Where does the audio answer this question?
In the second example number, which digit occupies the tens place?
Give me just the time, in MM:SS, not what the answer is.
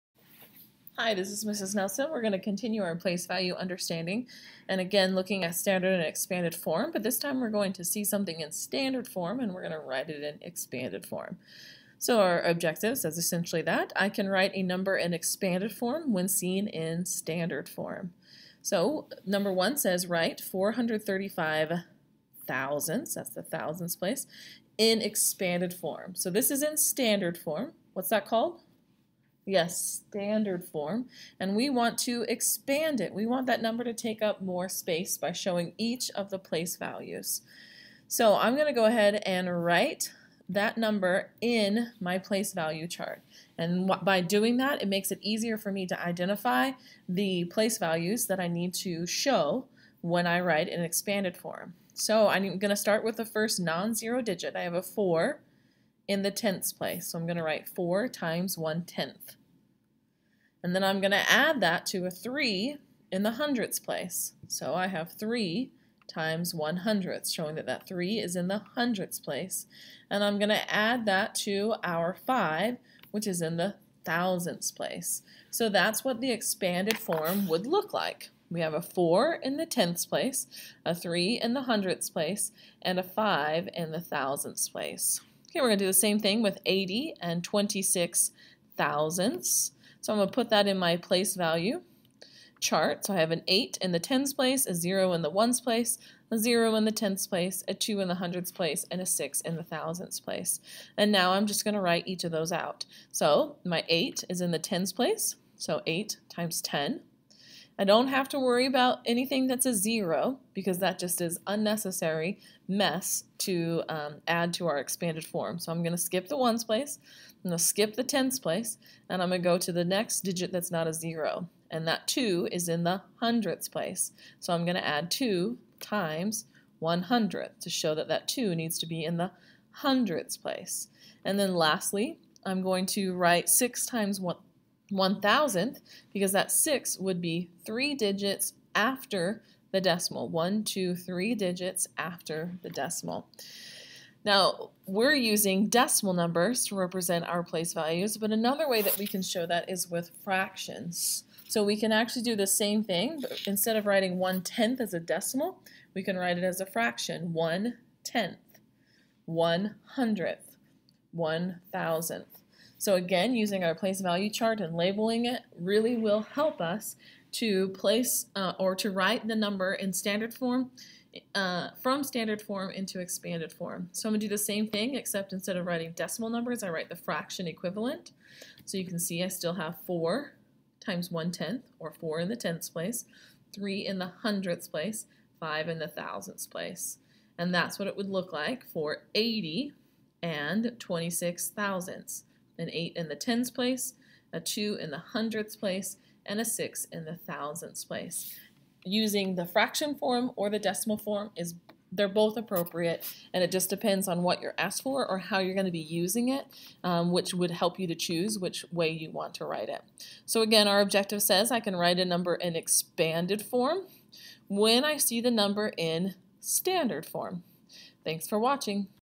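01:33.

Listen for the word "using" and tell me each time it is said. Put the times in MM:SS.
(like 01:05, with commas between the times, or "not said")
02:25, 02:43, 03:18, 03:25.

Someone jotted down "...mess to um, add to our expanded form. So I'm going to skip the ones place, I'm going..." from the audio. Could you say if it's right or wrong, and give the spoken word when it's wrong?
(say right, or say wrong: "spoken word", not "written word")
right.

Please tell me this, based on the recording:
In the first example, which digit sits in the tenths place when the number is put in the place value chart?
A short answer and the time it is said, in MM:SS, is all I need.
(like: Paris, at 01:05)
4, at 00:54.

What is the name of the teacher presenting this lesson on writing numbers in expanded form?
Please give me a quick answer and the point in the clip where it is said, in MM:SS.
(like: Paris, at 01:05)
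Mrs. Nelson, at 00:01.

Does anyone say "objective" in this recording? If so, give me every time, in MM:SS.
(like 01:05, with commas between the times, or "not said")
00:12, 03:30.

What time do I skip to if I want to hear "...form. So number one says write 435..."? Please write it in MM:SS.
00:17.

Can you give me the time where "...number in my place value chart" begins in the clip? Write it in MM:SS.
00:40.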